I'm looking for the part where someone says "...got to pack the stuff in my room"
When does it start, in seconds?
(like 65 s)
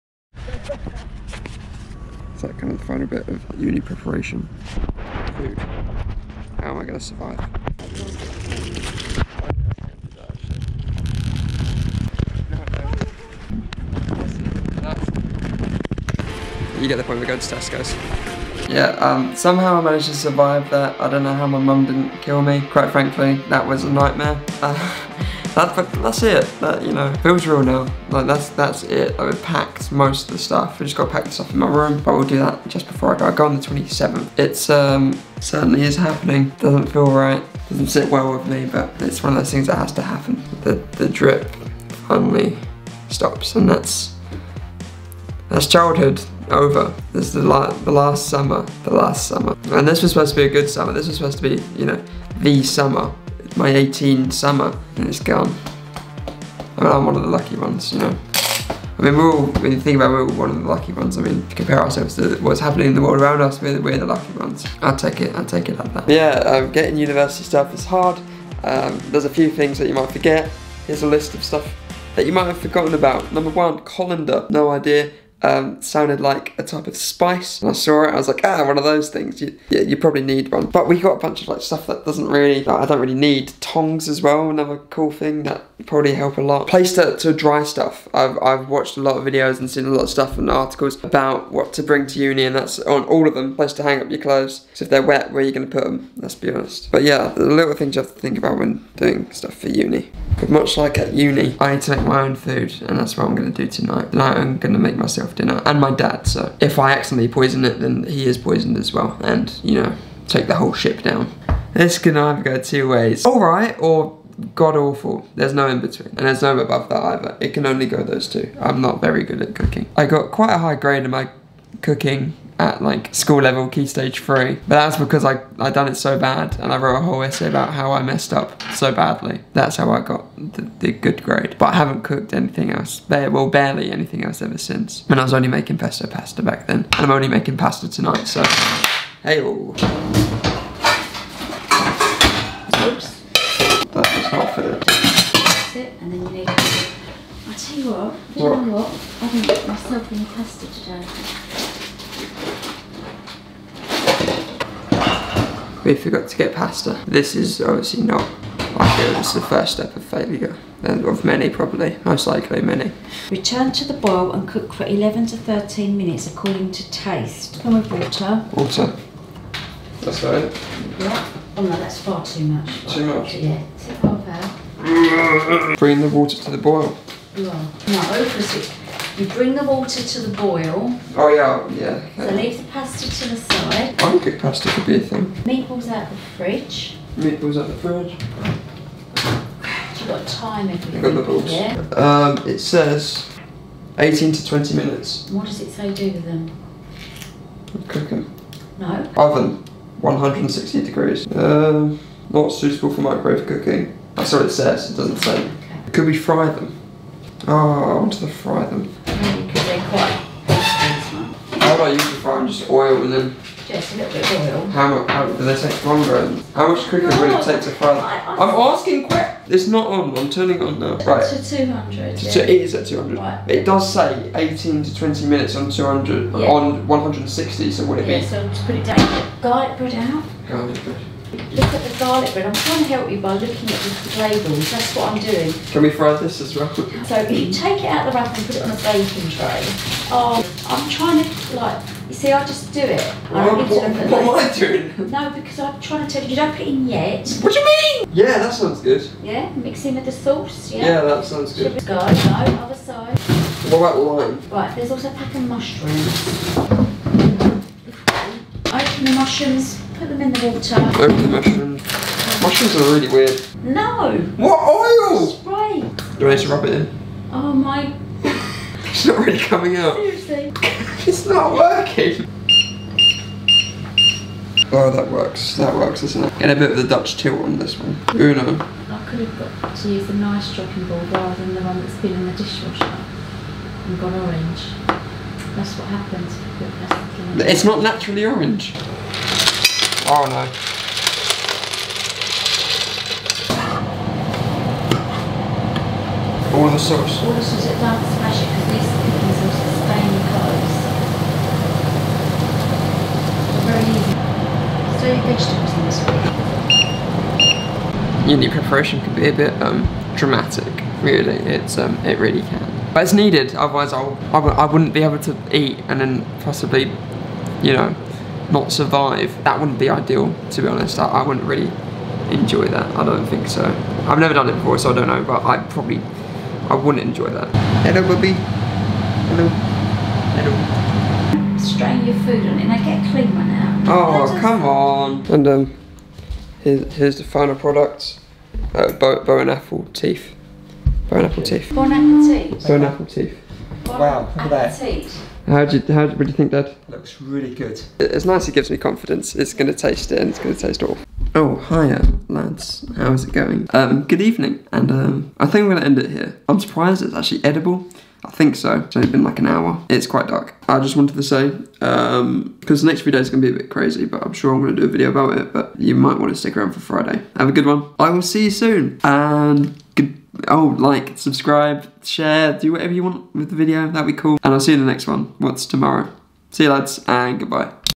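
30 s.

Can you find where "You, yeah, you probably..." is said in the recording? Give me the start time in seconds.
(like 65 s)
79 s.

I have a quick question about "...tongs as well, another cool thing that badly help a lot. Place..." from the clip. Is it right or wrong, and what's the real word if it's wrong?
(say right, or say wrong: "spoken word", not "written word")
wrong: "probably", not "badly".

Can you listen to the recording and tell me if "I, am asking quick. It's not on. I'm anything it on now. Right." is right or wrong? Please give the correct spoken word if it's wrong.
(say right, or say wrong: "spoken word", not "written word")
wrong: "turning", not "anything".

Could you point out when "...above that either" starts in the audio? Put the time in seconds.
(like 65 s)
116 s.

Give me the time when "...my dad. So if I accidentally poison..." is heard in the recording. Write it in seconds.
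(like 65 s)
105 s.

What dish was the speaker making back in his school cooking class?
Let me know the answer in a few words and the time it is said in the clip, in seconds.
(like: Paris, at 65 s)
Pesto pasta, at 135 s.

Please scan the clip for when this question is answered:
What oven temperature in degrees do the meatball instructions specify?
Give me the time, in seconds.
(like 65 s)
200 s.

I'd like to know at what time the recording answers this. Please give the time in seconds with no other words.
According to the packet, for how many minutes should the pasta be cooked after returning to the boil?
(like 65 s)
164 s.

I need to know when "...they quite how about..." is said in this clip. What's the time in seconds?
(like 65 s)
209 s.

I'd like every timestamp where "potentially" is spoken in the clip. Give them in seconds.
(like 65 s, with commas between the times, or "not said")
not said.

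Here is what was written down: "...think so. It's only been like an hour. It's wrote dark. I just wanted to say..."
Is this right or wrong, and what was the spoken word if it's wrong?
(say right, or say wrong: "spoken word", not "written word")
wrong: "quite", not "wrote".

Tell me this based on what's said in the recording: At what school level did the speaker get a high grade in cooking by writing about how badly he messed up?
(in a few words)
Key stage three.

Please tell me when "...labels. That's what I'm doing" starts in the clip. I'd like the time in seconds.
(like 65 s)
234 s.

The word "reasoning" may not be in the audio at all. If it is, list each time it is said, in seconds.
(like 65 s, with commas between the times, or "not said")
not said.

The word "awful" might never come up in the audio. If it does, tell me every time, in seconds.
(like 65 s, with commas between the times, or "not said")
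114 s, 350 s.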